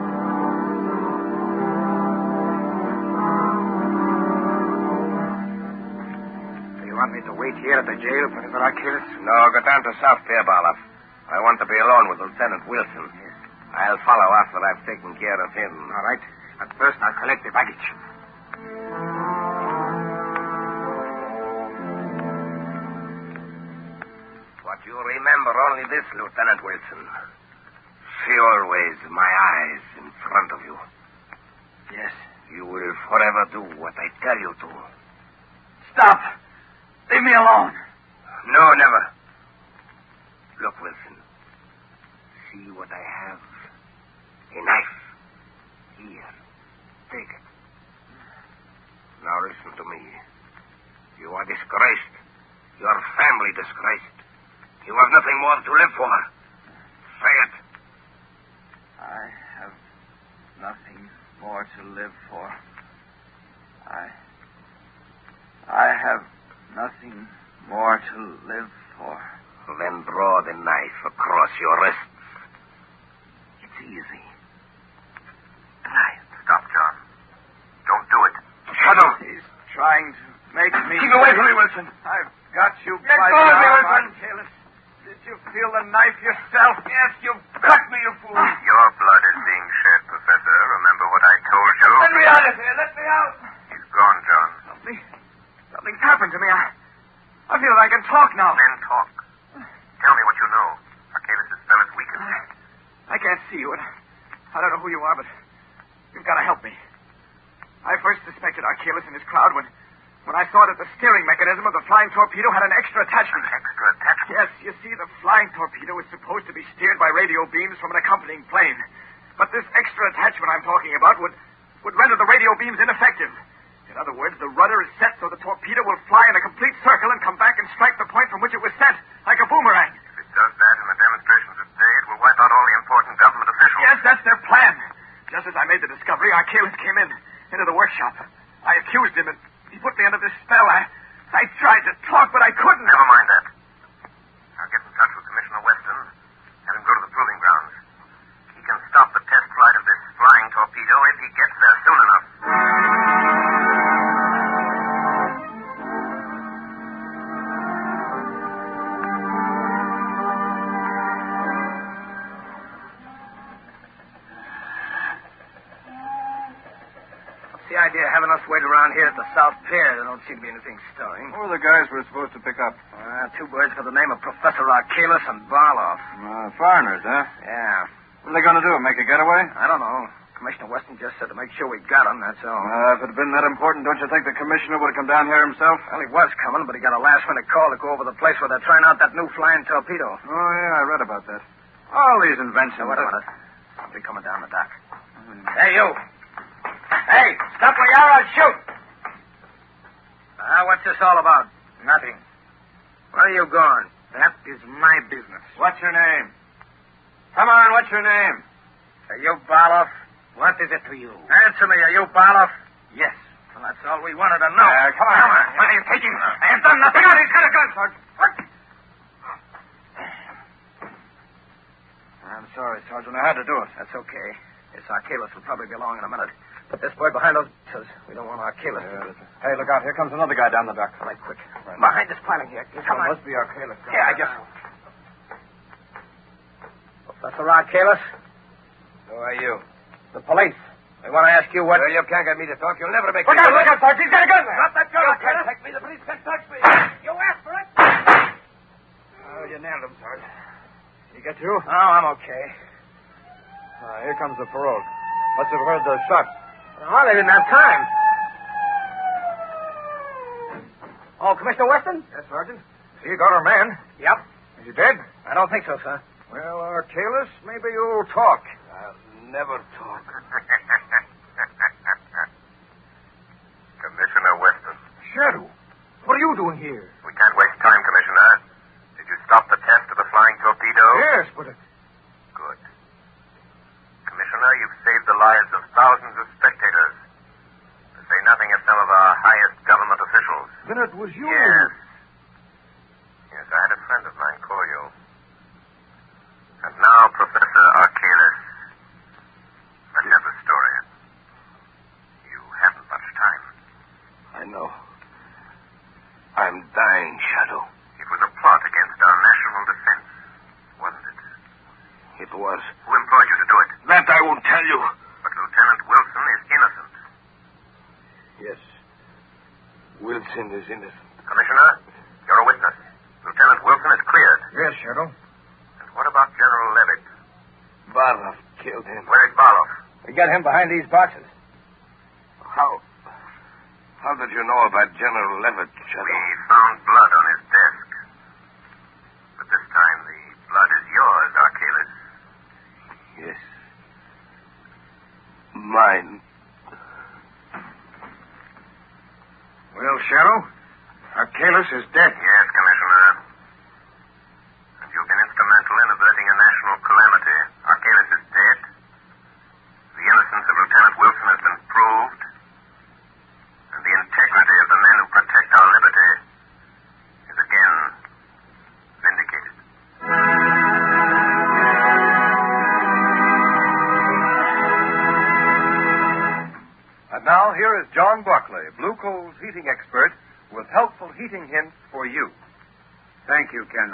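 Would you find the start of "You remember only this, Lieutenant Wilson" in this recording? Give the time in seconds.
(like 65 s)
24 s.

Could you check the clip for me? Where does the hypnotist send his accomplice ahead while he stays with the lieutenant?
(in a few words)
South Pierbalov.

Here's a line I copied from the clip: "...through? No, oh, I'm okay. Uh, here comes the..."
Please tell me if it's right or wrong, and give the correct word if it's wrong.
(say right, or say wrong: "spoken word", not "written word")
right.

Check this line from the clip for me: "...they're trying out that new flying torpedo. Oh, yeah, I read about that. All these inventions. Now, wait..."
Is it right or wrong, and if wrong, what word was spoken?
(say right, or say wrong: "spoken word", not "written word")
right.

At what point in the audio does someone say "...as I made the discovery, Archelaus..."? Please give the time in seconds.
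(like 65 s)
135 s.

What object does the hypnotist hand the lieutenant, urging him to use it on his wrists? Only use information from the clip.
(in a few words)
A knife.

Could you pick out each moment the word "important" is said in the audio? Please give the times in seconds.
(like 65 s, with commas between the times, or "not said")
132 s, 183 s.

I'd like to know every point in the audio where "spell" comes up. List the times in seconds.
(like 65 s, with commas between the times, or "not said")
101 s, 140 s.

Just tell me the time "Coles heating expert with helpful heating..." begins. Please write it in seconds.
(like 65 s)
379 s.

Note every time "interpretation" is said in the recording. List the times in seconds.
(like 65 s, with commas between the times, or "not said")
not said.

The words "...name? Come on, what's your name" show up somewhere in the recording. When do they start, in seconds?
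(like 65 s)
205 s.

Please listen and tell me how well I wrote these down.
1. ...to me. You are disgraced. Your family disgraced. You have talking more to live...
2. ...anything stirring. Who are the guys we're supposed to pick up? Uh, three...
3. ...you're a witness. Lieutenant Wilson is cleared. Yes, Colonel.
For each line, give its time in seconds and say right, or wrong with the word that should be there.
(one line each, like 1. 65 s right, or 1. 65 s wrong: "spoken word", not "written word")
1. 49 s wrong: "nothing", not "talking"
2. 170 s wrong: "two", not "three"
3. 322 s right.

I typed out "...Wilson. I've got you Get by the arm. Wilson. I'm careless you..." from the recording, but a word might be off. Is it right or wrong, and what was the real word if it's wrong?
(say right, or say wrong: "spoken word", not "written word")
right.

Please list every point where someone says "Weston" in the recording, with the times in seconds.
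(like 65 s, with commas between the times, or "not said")
180 s, 261 s, 274 s.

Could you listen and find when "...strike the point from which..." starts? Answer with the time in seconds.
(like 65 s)
127 s.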